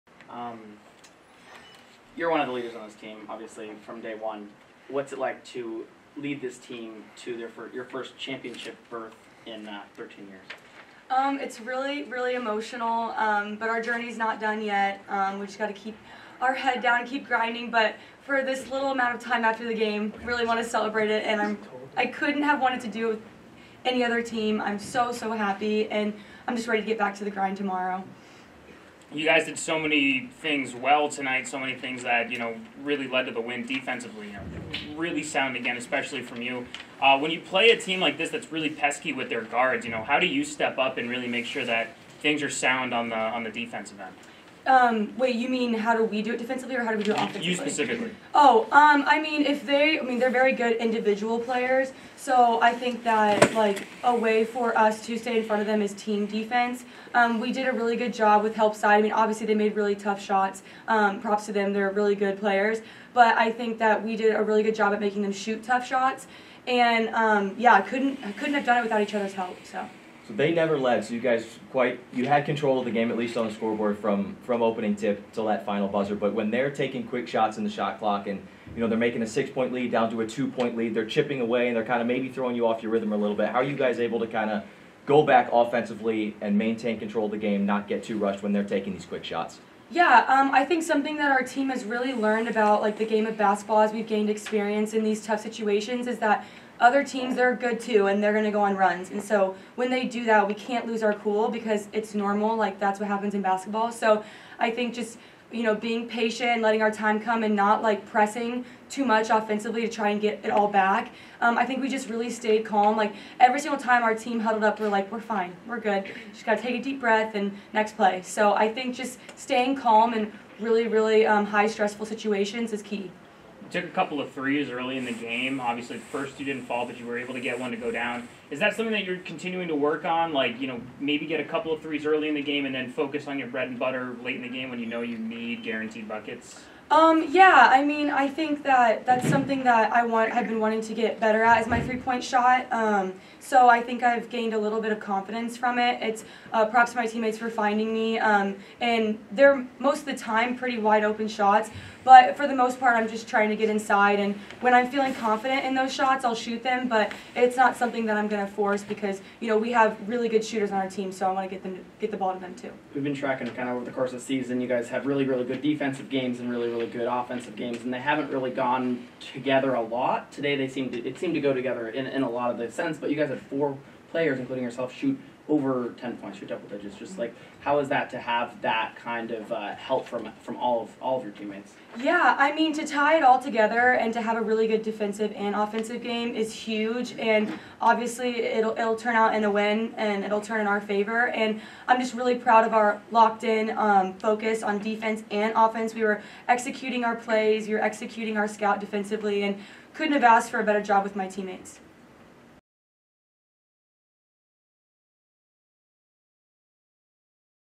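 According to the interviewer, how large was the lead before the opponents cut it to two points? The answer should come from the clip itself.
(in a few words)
6 points.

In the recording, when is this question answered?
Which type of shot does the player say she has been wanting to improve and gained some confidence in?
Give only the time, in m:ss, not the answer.
2:21.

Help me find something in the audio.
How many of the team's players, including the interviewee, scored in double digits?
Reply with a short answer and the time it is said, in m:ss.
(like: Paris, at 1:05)
4, at 2:53.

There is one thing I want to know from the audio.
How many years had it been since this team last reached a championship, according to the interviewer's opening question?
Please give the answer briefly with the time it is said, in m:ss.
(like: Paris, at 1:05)
13, at 0:09.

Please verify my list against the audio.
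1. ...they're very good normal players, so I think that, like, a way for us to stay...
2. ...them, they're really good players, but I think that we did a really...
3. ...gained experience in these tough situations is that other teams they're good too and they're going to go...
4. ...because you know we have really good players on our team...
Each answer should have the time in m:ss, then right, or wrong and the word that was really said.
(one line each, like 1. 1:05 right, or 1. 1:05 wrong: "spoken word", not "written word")
1. 0:50 wrong: "individual", not "normal"
2. 1:01 right
3. 1:34 right
4. 2:38 wrong: "shooters", not "players".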